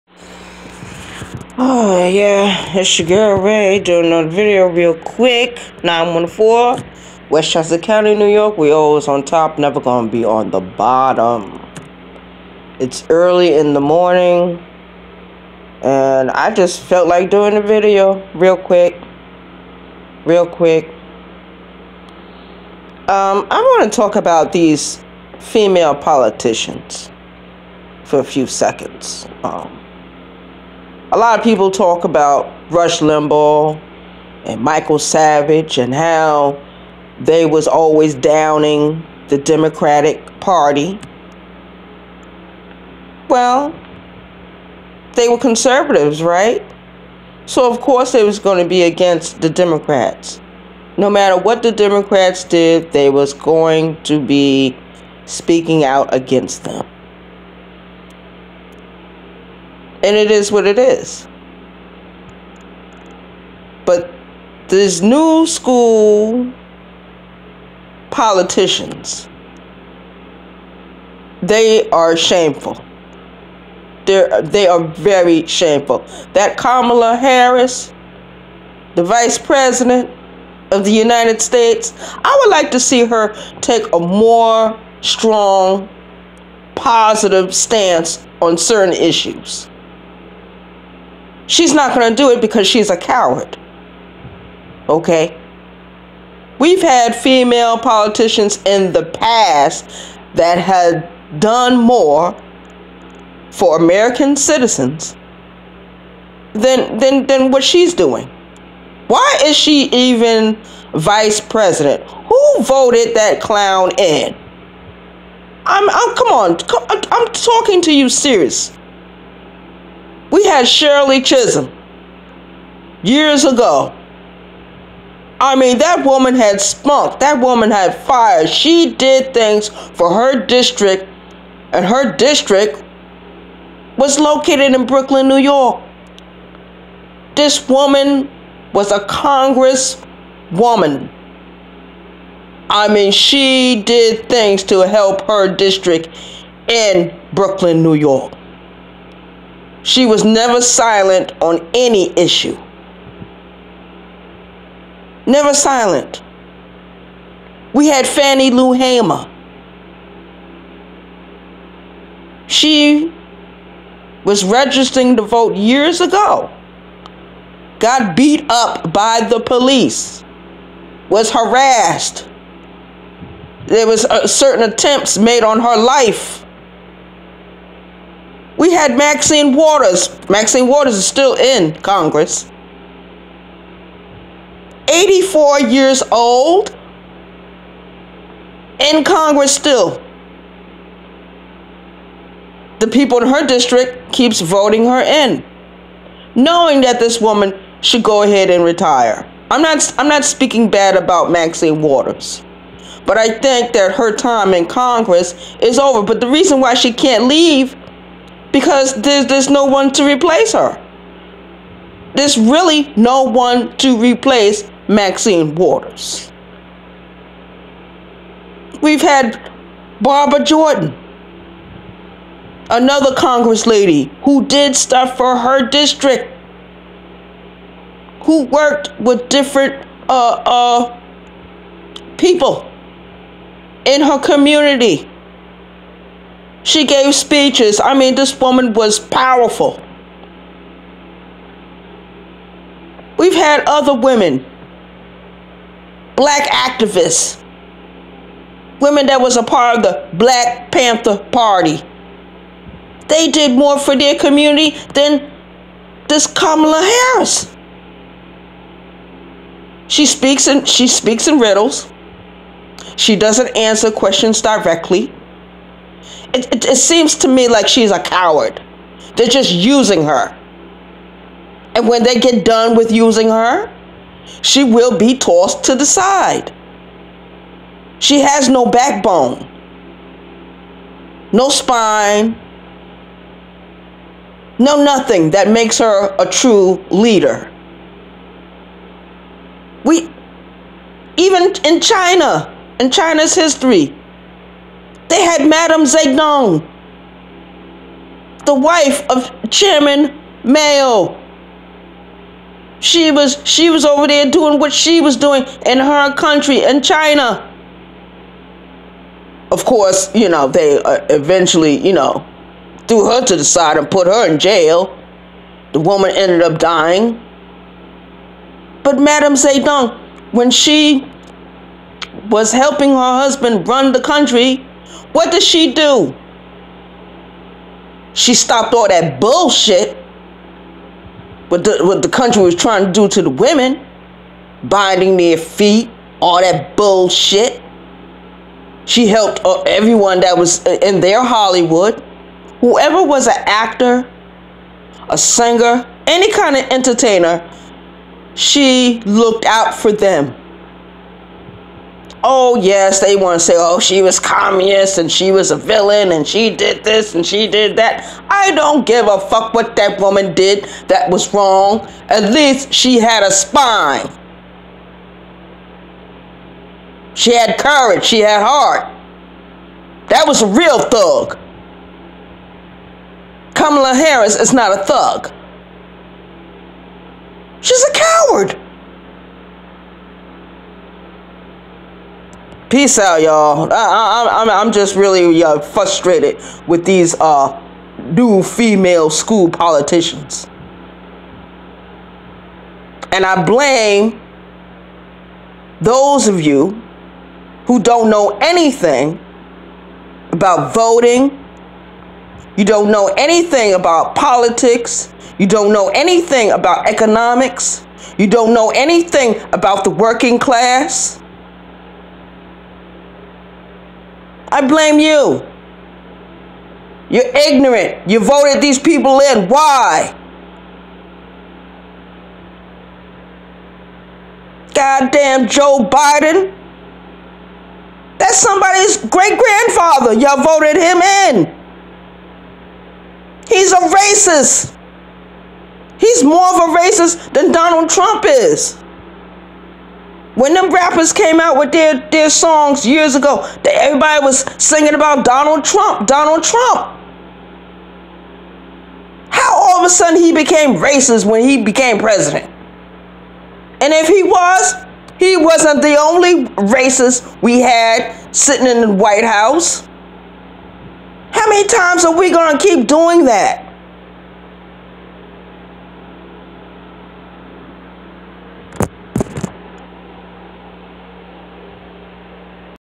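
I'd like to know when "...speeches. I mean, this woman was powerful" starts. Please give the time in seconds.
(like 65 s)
237 s.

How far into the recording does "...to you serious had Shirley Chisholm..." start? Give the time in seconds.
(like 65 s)
117 s.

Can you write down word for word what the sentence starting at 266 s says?
It, it, it seems to me like she's a coward.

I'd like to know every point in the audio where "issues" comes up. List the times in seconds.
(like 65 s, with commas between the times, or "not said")
88 s, 152 s.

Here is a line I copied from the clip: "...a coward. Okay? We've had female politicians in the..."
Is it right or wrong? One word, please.
right.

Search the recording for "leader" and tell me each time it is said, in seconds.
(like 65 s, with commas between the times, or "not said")
286 s.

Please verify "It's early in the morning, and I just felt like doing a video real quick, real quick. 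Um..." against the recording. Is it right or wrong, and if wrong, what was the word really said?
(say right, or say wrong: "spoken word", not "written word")
right.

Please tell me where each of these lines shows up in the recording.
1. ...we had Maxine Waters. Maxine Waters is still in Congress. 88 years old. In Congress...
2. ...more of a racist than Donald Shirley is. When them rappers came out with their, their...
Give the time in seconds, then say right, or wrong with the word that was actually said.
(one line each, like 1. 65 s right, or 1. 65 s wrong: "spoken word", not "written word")
1. 178 s wrong: "84", not "88"
2. 436 s wrong: "Trump", not "Shirley".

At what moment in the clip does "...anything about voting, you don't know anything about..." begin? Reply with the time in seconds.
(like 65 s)
398 s.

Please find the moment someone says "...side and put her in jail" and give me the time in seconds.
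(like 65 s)
313 s.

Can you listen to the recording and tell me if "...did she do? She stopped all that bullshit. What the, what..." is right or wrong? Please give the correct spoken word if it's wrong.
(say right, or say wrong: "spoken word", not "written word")
right.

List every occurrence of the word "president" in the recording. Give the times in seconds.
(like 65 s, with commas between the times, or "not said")
79 s, 111 s, 451 s.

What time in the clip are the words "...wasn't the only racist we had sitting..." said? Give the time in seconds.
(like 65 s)
455 s.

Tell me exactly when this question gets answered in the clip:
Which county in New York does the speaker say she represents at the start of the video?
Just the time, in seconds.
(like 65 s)
7 s.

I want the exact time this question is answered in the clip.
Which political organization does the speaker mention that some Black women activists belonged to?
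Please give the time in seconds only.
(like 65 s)
250 s.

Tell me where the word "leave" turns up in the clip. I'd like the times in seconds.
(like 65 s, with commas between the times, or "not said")
207 s.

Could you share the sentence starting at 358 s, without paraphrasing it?
I don't give a fuck what that woman did that was wrong.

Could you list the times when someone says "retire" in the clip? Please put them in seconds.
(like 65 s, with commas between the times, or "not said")
198 s.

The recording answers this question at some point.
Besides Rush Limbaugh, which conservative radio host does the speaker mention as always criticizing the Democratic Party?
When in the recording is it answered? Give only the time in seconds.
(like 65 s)
34 s.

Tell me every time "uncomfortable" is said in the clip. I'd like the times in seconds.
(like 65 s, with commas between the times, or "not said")
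not said.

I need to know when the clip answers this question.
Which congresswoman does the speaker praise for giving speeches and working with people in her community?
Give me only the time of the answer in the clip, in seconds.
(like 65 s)
220 s.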